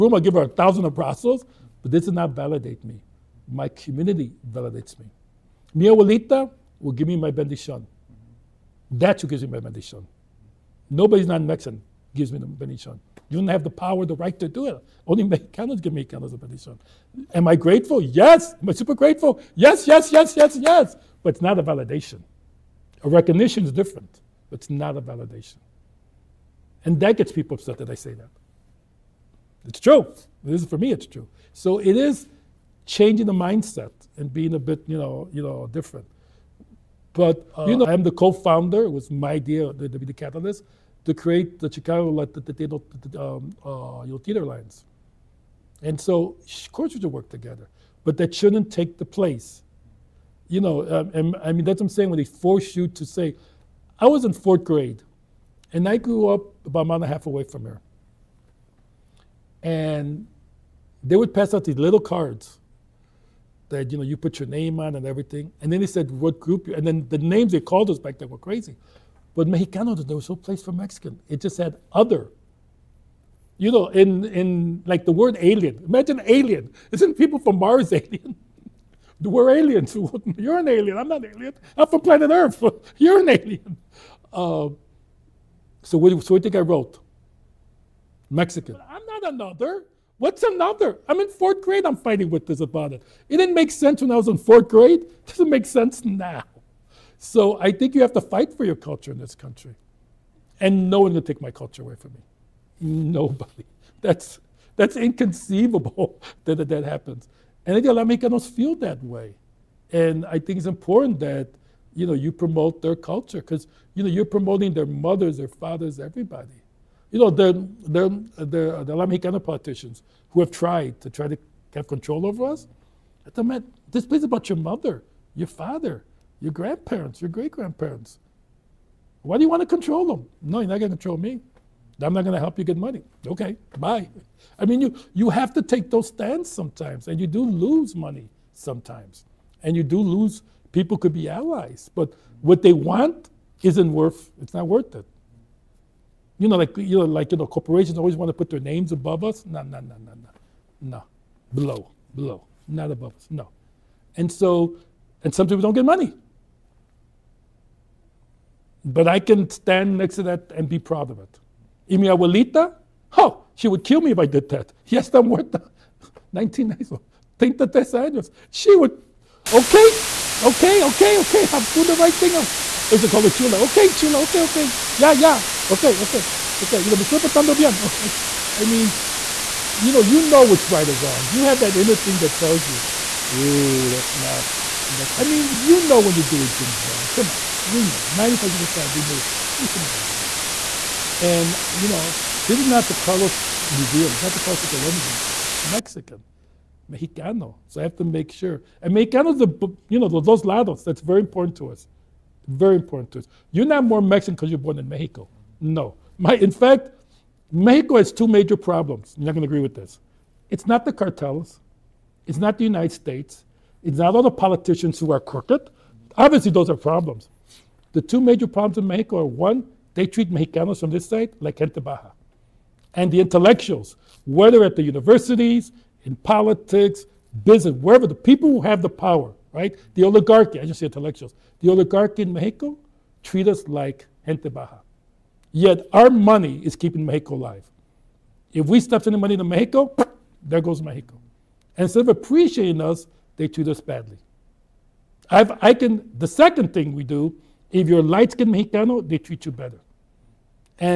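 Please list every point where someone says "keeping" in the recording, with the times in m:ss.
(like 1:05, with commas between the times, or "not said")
3:56.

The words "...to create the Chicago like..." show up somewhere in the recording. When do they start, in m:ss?
0:41.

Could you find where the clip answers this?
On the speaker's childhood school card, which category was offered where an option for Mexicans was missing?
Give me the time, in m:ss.
1:11.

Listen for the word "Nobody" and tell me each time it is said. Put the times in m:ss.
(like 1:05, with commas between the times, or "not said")
0:10, 1:42.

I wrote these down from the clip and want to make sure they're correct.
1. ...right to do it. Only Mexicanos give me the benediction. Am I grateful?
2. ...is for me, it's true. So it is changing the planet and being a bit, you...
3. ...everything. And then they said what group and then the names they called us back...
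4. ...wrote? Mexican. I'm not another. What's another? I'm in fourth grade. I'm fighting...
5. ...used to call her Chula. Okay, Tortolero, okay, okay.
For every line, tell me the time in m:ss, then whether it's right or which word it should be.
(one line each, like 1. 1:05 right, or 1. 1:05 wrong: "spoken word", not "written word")
1. 0:14 right
2. 0:30 wrong: "mindset", not "planet"
3. 1:05 right
4. 1:26 right
5. 2:52 wrong: "Chula", not "Tortolero".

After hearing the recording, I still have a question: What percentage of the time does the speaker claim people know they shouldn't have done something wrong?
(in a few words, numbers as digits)
95%.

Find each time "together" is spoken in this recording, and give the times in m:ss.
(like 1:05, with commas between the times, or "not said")
0:47.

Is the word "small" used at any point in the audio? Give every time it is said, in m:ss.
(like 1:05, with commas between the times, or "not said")
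not said.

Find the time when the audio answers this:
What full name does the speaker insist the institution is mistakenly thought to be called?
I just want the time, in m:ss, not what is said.
3:14.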